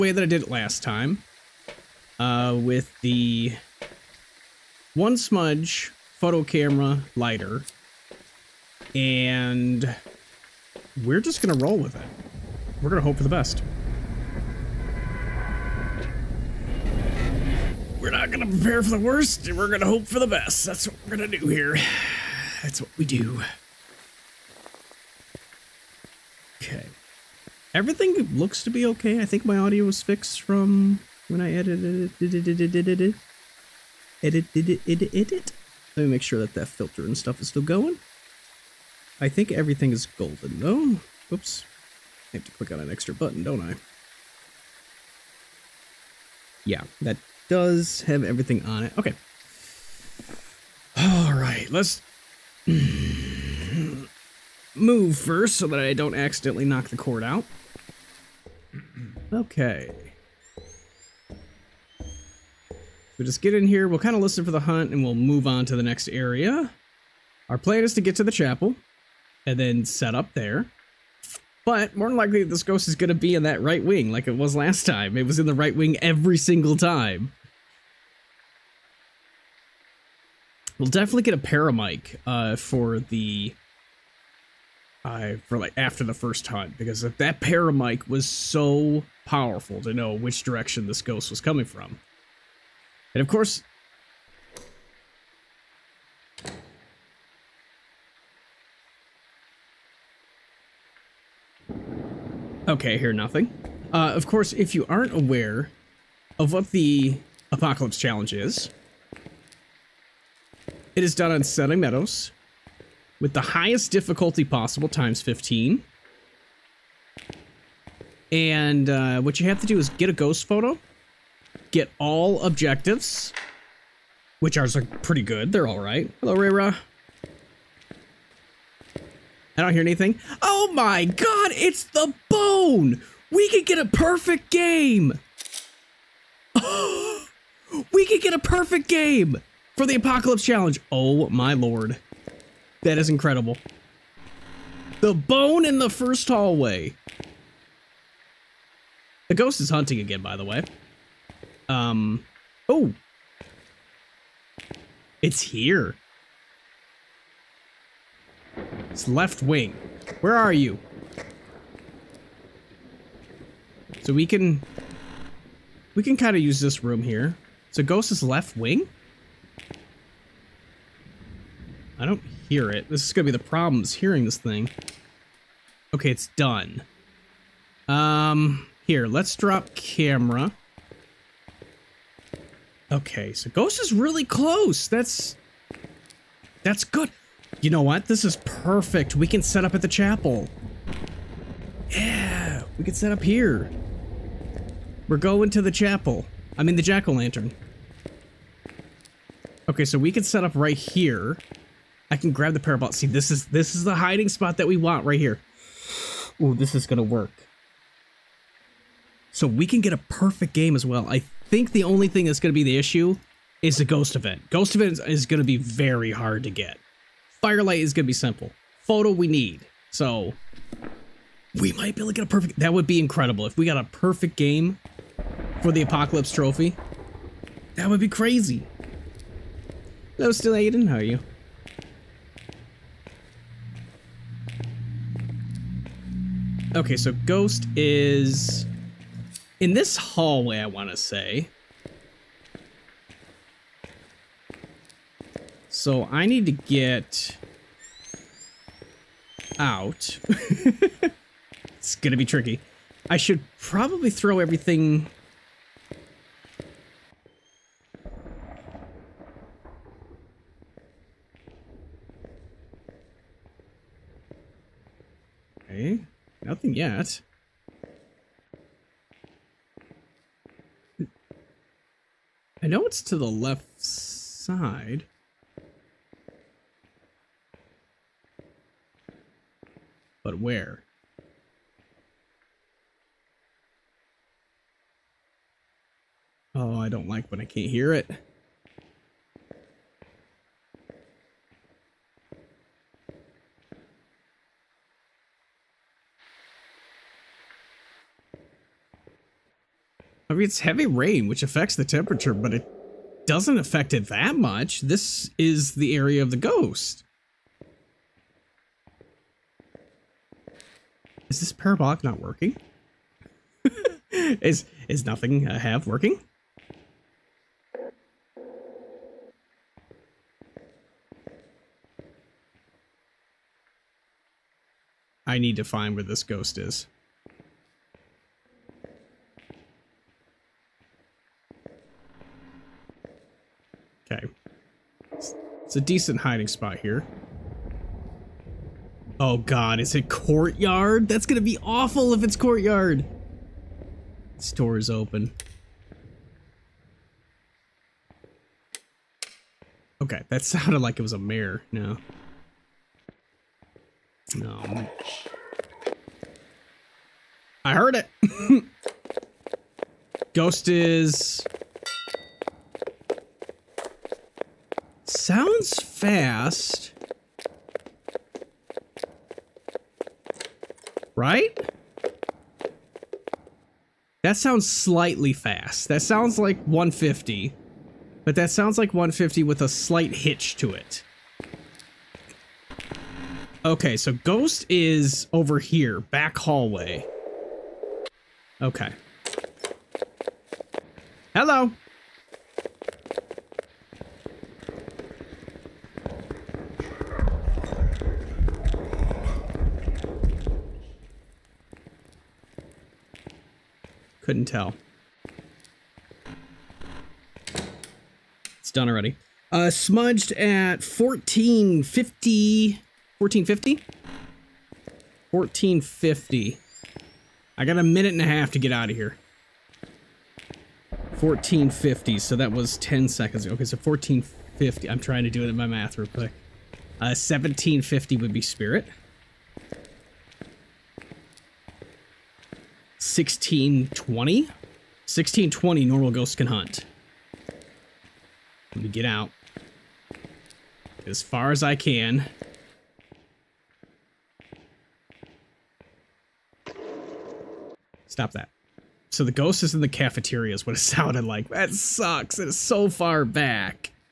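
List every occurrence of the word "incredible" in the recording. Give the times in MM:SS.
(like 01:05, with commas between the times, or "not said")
02:23, 03:42.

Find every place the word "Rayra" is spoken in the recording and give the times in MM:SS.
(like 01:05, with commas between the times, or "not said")
02:06.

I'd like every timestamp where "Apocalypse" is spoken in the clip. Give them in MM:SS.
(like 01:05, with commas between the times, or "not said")
01:47, 02:19, 03:45.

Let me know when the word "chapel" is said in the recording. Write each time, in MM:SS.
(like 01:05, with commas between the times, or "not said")
01:08, 03:09, 03:15.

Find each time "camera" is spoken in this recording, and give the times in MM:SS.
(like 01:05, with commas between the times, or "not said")
00:06, 02:59.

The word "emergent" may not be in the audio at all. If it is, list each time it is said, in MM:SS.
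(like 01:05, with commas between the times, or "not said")
not said.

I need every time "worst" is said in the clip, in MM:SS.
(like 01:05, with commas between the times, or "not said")
00:18.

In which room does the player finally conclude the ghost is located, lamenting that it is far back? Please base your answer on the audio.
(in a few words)
The cafeteria.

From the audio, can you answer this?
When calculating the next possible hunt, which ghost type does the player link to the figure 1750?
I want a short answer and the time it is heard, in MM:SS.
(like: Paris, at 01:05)
Spirit, at 07:08.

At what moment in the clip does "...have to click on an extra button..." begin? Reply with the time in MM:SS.
00:42.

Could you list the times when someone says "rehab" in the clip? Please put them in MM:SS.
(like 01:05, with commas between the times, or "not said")
not said.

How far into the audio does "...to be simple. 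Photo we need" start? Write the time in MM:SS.
03:38.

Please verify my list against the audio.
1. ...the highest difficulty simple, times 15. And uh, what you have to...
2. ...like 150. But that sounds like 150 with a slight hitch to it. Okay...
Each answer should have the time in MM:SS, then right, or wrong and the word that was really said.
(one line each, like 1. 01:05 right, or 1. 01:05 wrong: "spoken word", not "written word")
1. 01:53 wrong: "possible", not "simple"
2. 06:16 right.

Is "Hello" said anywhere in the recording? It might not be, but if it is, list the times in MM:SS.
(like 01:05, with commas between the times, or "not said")
02:06, 03:50.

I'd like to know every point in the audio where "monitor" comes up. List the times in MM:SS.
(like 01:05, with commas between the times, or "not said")
not said.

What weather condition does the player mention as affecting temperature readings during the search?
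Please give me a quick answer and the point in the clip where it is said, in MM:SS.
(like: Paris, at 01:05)
Heavy rain, at 05:00.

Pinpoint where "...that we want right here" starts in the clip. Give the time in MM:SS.
03:24.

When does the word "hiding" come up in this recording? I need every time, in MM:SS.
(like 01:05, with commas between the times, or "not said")
03:23, 05:36.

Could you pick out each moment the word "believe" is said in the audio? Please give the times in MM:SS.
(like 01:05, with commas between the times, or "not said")
not said.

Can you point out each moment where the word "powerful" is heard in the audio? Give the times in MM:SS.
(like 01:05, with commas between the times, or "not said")
01:29.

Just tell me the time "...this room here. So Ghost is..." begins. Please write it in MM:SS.
02:46.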